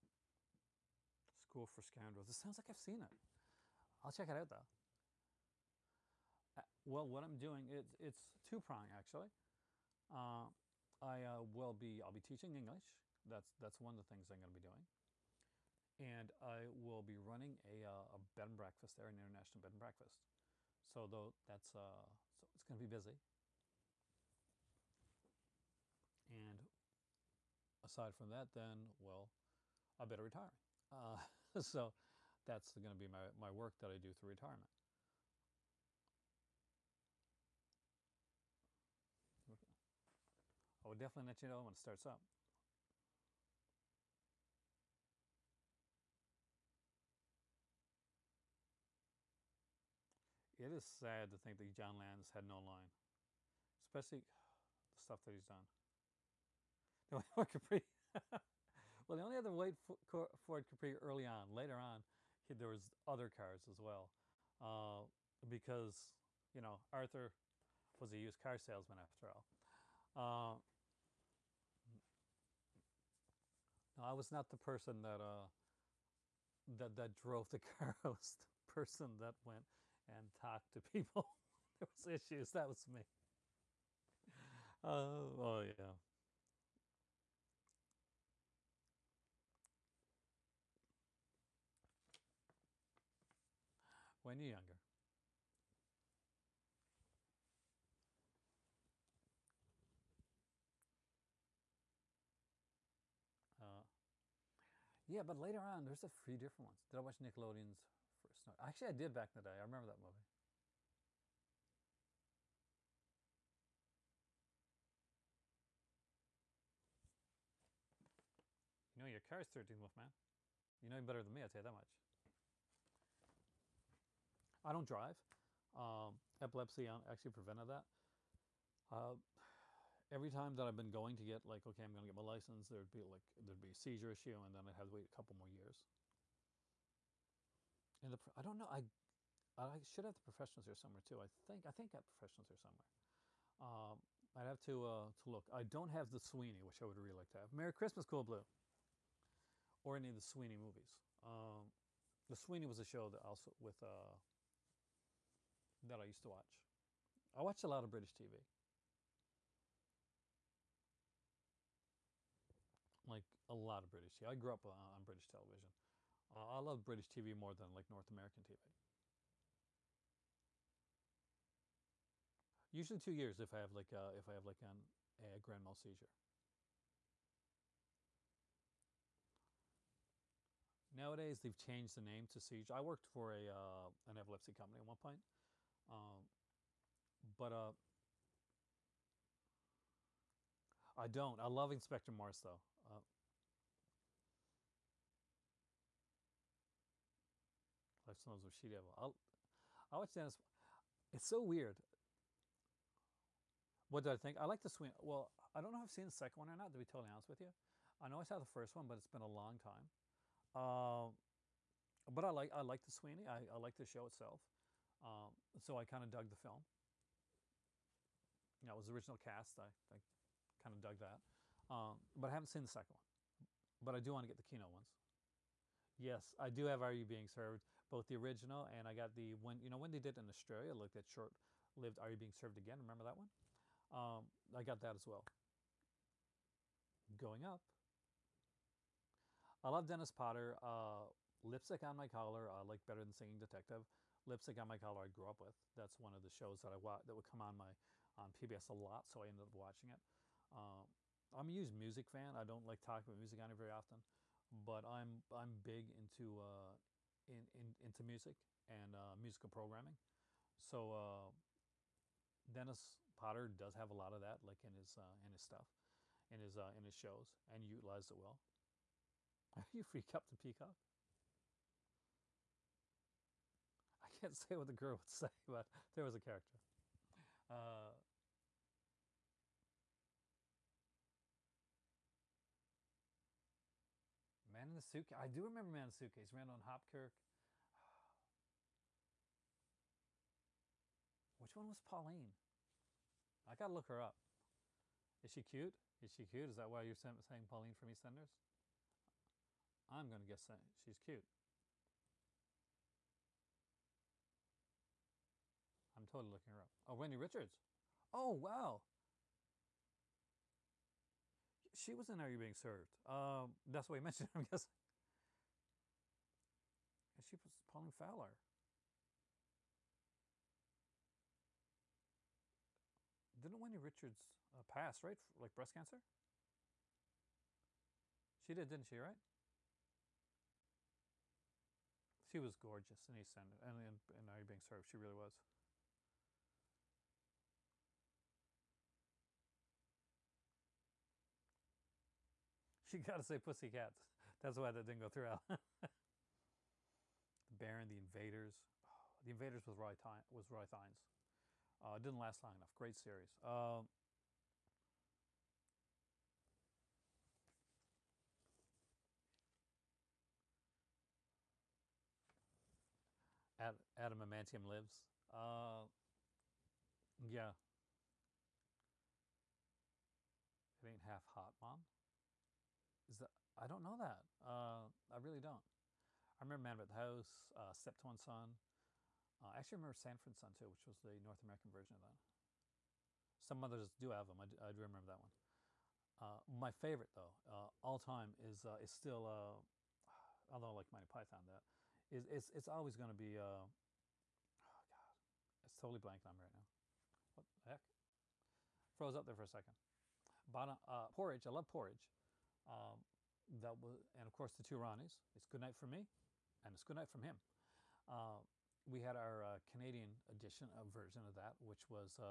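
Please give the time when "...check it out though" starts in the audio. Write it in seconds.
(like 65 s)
4 s.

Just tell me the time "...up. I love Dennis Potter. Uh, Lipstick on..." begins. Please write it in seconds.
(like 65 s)
237 s.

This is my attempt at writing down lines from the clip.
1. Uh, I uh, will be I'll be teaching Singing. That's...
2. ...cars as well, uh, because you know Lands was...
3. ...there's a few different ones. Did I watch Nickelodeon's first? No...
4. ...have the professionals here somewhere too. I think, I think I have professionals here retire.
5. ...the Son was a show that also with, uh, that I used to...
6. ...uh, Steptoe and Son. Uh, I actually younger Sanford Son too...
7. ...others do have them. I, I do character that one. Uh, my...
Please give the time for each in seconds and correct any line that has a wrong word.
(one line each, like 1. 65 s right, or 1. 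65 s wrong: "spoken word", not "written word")
1. 10 s wrong: "English", not "Singing"
2. 63 s wrong: "Arthur", not "Lands"
3. 105 s right
4. 140 s wrong: "somewhere", not "retire"
5. 152 s wrong: "Sweeney", not "Son"
6. 377 s wrong: "remember", not "younger"
7. 383 s wrong: "remember", not "character".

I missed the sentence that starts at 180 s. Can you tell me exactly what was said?
Nowadays they've changed the name to seizure.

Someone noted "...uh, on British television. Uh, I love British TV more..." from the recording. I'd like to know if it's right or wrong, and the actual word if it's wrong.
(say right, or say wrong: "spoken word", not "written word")
right.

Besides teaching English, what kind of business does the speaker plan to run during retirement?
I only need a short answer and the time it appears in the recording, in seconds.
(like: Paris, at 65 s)
International bed and breakfast, at 19 s.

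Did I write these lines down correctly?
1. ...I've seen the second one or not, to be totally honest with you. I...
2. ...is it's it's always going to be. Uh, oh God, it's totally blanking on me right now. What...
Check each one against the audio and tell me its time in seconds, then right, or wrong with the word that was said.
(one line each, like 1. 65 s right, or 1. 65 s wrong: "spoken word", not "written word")
1. 205 s right
2. 392 s right.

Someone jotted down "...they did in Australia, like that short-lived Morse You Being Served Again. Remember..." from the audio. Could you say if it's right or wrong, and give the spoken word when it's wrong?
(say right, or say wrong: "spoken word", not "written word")
wrong: "Are", not "Morse".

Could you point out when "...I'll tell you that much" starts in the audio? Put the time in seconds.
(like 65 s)
121 s.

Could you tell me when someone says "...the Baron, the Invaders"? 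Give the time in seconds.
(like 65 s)
345 s.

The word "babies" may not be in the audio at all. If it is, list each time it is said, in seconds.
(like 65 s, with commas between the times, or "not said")
not said.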